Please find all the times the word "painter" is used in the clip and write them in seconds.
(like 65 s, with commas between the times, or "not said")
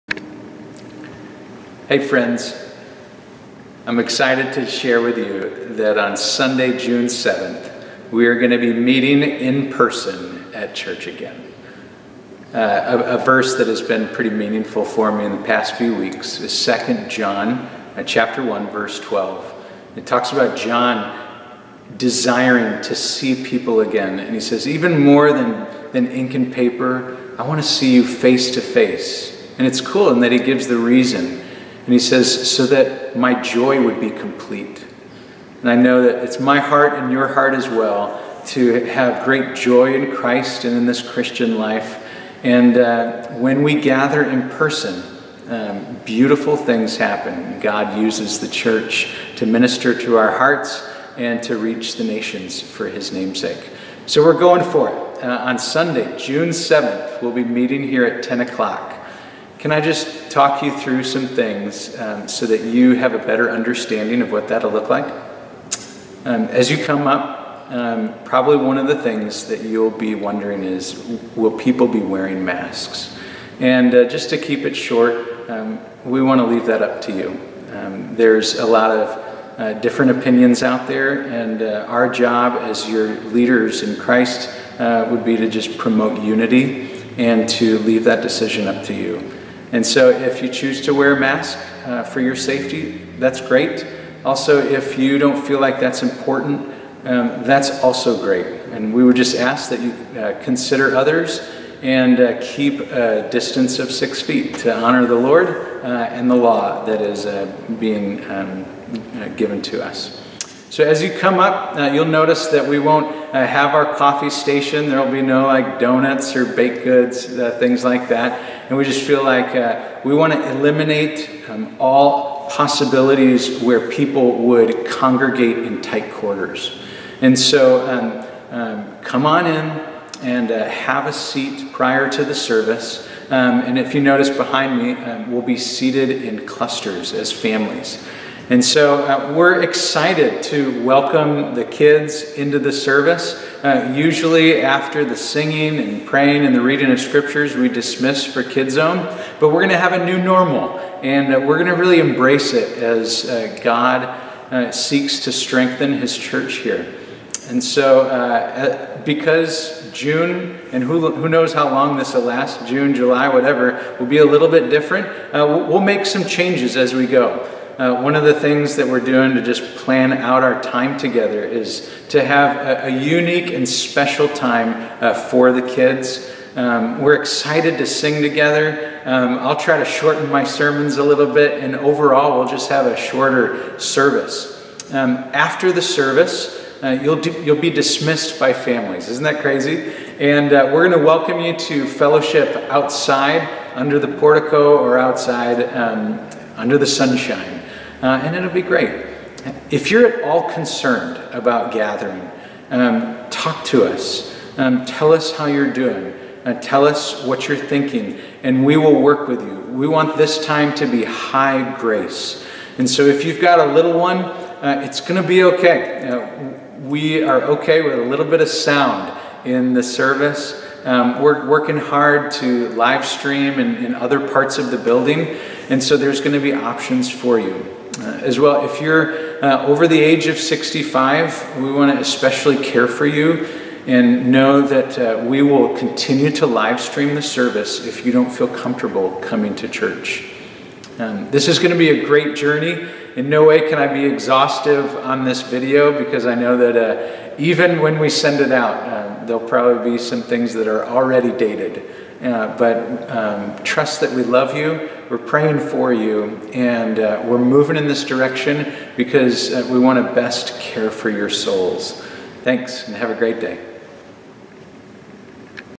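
not said.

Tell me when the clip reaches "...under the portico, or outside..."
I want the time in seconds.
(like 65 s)
193 s.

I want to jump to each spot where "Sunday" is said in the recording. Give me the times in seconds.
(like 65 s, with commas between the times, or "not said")
6 s, 55 s.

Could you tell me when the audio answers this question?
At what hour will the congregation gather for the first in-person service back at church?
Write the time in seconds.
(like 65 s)
58 s.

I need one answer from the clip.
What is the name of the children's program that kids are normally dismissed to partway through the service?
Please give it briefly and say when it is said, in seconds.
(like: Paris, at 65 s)
Kids Zone, at 148 s.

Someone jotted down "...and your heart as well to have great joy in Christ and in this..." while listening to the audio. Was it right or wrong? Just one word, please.
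right.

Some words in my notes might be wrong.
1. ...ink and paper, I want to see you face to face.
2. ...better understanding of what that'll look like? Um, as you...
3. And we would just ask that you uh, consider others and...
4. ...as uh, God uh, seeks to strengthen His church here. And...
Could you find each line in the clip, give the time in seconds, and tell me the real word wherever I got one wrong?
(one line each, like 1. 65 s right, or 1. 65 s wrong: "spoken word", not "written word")
1. 26 s right
2. 63 s right
3. 98 s right
4. 152 s right.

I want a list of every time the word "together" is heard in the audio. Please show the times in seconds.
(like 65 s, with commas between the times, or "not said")
170 s, 178 s.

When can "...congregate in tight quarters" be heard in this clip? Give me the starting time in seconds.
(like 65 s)
124 s.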